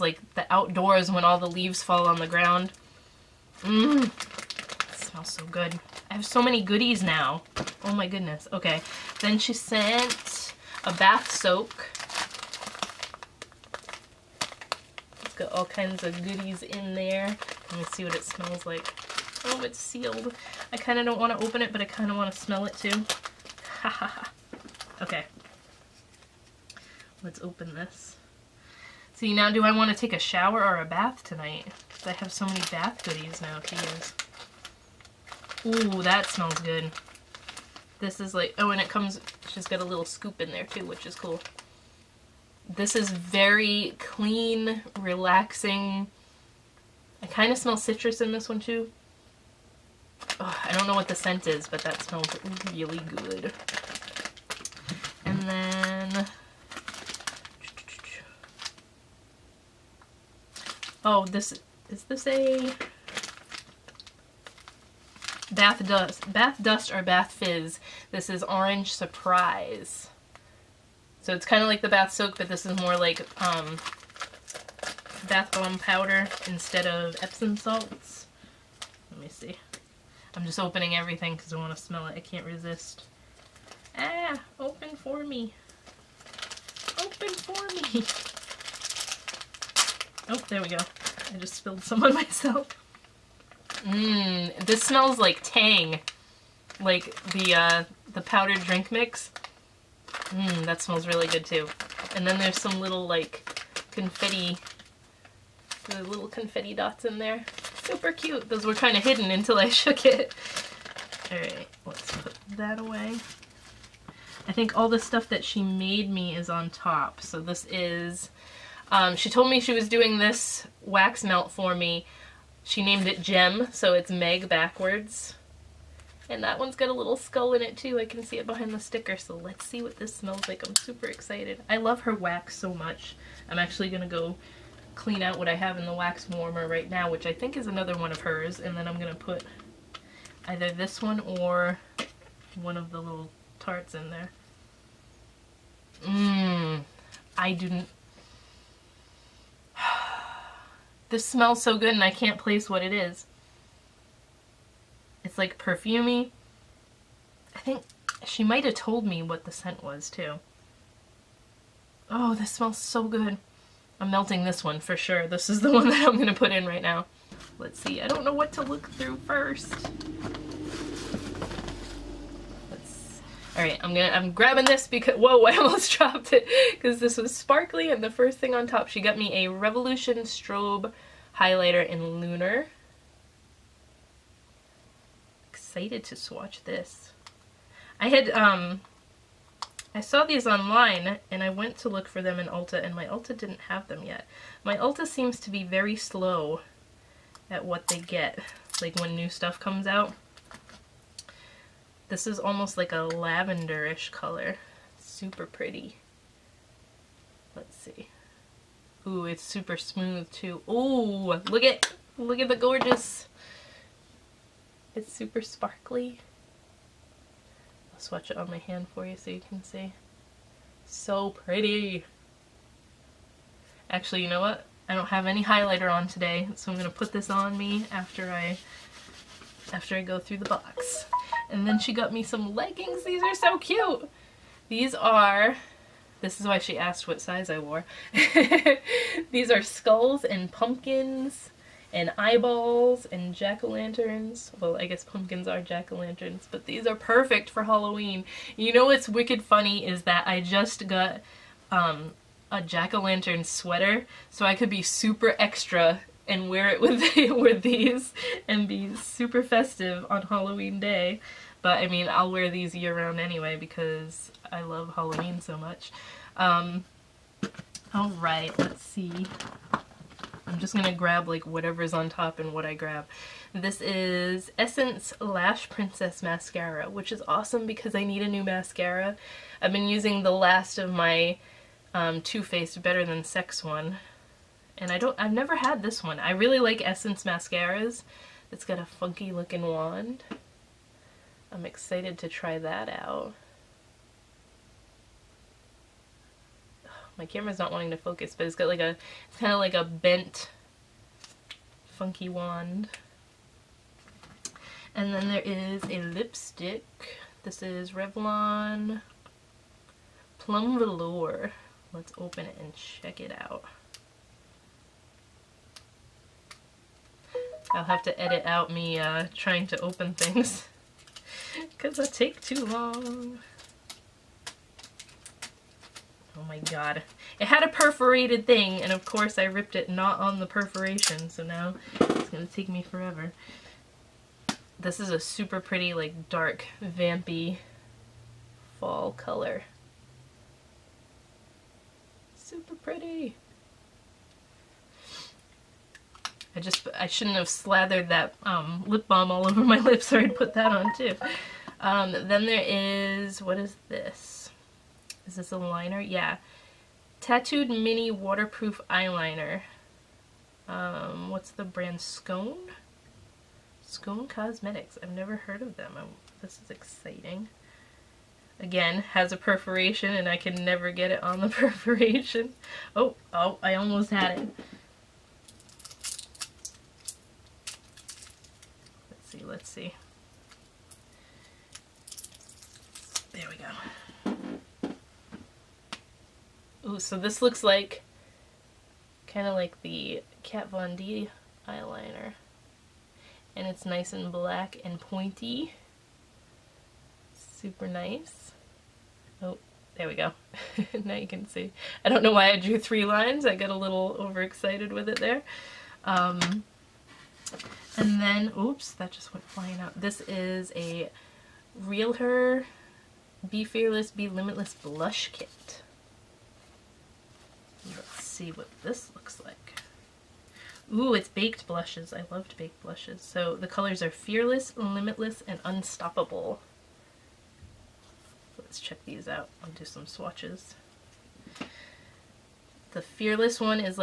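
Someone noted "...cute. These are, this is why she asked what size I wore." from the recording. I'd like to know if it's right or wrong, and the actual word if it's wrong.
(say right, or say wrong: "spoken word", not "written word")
right.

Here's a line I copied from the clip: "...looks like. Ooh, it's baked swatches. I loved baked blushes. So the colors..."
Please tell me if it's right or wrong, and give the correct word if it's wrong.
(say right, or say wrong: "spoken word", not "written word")
wrong: "blushes", not "swatches".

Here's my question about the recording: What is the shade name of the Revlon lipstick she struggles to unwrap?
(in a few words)
Plum Velour.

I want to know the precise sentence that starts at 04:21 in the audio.
But I mean, I'll wear these year round anyway because I love Halloween so much.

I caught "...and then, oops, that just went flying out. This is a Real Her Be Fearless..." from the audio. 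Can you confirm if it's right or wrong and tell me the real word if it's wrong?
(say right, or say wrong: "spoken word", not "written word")
right.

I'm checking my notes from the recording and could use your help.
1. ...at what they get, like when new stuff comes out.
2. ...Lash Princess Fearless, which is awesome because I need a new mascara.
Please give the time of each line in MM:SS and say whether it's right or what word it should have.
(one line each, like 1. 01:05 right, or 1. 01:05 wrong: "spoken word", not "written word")
1. 03:17 right
2. 04:35 wrong: "Mascara", not "Fearless".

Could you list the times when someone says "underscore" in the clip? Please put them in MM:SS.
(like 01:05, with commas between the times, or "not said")
not said.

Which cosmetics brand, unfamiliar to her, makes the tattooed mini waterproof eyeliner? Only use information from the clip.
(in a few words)
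Scone Cosmetics.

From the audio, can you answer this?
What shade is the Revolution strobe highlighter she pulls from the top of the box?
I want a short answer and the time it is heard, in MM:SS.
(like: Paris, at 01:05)
Lunar, at 03:02.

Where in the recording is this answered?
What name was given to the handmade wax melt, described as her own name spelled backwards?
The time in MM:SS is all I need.
02:03.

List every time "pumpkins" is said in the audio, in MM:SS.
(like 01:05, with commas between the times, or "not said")
04:00, 04:05.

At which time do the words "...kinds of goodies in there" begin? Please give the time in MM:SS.
00:15.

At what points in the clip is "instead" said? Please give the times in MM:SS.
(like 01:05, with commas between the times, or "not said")
01:16.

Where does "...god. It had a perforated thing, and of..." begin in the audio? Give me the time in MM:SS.
05:26.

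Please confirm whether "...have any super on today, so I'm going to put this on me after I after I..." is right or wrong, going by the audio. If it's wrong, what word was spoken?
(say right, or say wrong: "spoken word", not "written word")
wrong: "highlighter", not "super".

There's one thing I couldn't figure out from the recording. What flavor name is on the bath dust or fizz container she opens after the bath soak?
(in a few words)
Orange Surprise.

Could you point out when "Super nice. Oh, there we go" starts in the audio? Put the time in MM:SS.
06:37.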